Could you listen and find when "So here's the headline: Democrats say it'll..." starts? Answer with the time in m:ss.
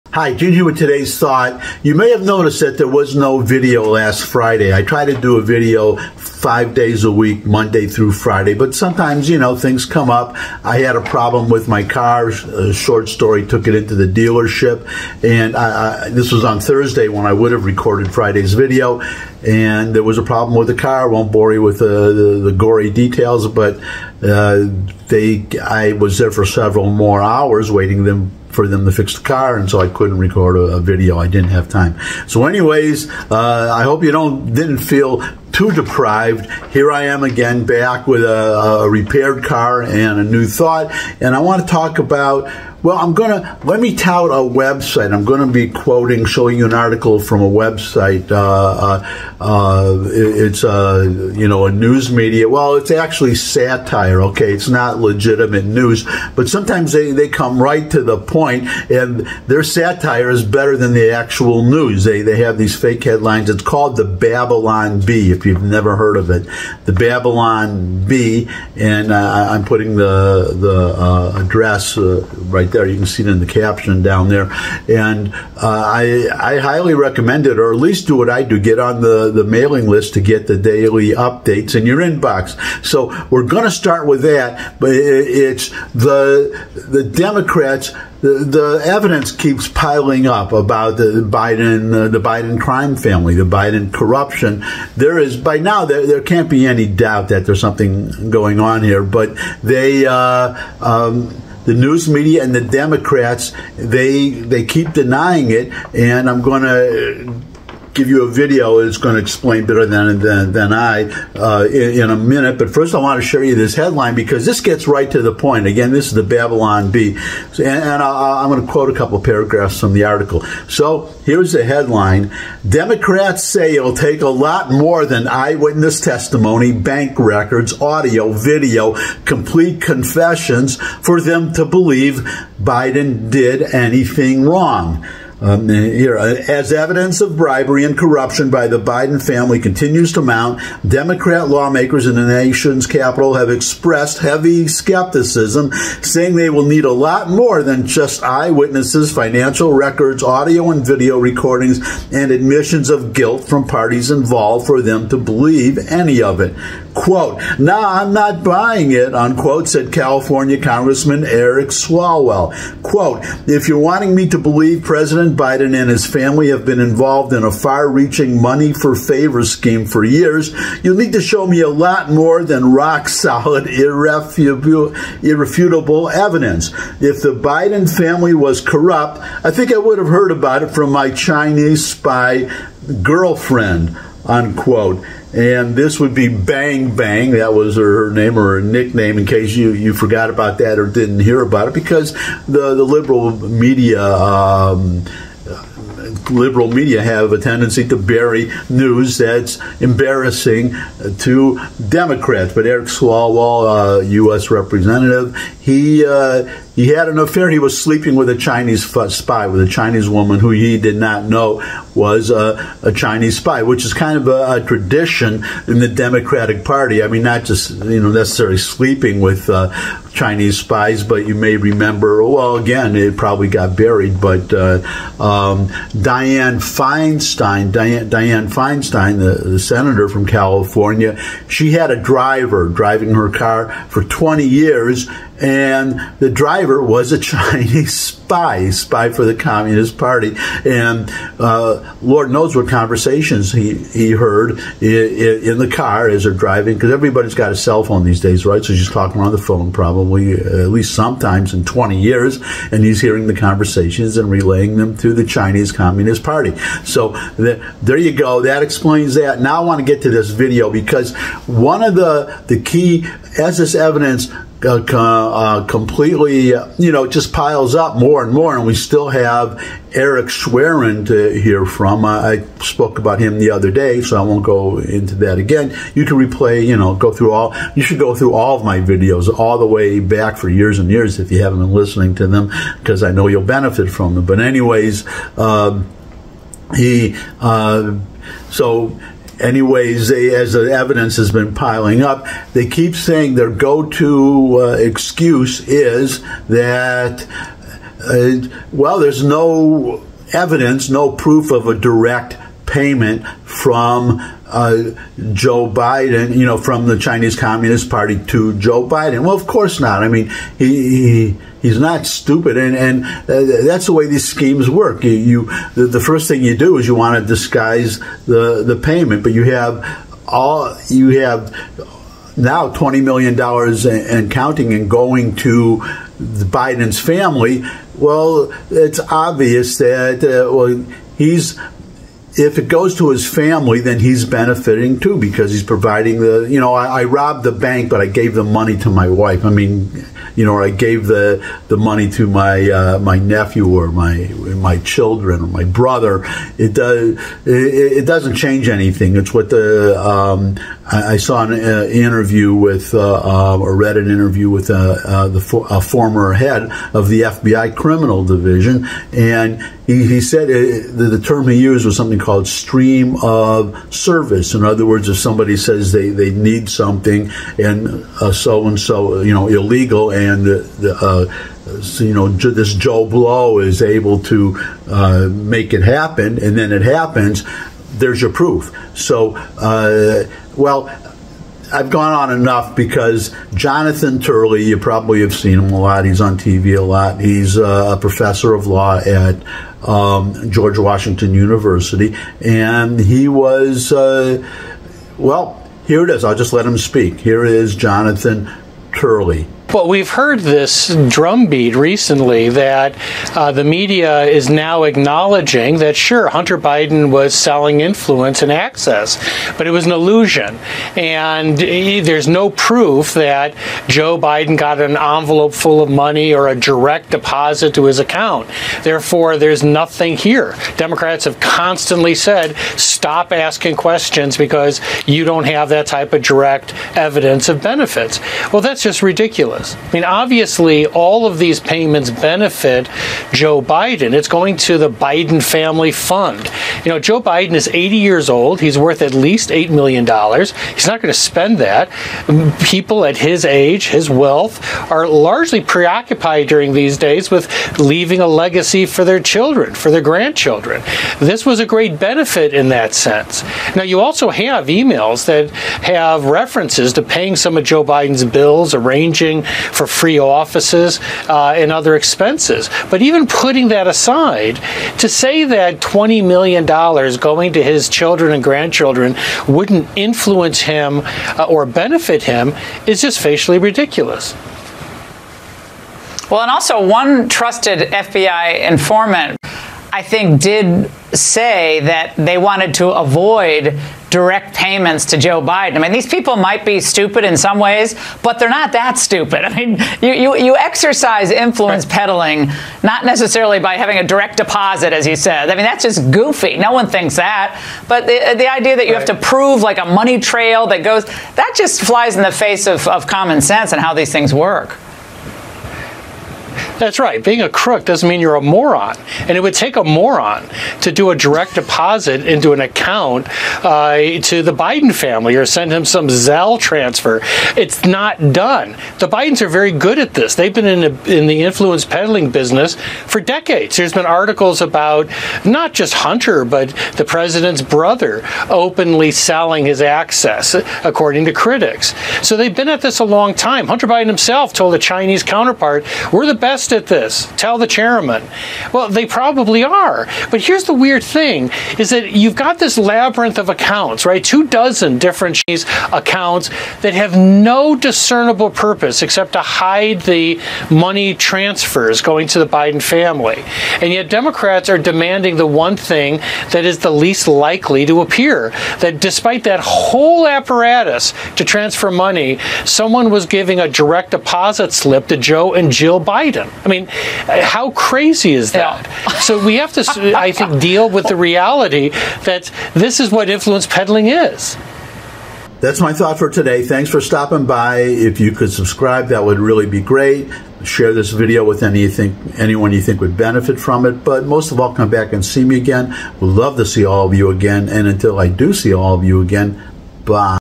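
2:00.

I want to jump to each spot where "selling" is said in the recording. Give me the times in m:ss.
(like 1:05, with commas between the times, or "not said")
6:47, 8:49.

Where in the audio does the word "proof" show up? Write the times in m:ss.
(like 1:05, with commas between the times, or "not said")
5:01, 6:18, 6:52.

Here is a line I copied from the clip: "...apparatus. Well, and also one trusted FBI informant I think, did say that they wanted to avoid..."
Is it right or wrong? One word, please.
wrong.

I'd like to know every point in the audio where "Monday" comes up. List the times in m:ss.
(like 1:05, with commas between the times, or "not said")
0:07.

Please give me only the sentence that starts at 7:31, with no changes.
This was a great benefit in that sense.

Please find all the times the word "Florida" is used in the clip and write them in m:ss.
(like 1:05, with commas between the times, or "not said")
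not said.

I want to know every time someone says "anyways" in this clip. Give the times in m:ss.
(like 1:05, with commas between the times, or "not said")
0:32, 4:44, 4:49.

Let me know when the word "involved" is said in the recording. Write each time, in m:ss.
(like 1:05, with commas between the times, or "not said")
2:34, 2:46.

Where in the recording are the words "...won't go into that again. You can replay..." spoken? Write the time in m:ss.
4:34.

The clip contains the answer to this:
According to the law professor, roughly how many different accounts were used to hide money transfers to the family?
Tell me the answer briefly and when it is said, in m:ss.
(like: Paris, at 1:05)
2 dozen, at 9:04.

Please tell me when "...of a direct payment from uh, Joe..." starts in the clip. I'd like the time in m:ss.
5:01.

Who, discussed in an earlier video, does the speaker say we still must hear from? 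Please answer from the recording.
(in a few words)
Eric Schwerin.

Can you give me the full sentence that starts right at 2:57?
If the Biden family was corrupt, I think I would have heard about it from my Chinese spy girlfriend unquote.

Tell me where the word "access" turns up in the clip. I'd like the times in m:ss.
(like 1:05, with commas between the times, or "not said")
6:48, 8:49.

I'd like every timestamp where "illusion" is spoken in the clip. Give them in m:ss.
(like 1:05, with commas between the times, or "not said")
6:49.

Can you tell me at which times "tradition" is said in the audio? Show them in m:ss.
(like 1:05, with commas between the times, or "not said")
3:34.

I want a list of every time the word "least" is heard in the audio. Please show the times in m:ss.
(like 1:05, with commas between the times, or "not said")
1:17, 4:10, 7:19, 9:16.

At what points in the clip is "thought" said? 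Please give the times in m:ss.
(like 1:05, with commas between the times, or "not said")
0:01, 0:40, 9:35.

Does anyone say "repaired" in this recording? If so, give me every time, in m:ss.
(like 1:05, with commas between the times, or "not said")
0:38.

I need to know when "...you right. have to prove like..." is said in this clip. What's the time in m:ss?
8:18.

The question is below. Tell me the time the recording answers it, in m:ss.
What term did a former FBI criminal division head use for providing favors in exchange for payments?
6:02.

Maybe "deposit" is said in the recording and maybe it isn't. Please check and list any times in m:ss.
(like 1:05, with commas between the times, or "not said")
6:57, 8:14, 8:31, 9:24.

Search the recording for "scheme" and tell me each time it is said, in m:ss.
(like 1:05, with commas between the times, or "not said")
2:49, 5:14.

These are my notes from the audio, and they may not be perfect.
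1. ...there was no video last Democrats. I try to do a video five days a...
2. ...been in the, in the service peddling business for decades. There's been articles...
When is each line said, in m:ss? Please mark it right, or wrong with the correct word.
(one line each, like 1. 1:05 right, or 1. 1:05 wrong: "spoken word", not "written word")
1. 0:02 wrong: "Friday", not "Democrats"
2. 8:40 wrong: "influence", not "service".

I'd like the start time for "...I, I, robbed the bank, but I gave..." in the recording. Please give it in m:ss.
5:36.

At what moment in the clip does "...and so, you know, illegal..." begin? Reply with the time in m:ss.
6:08.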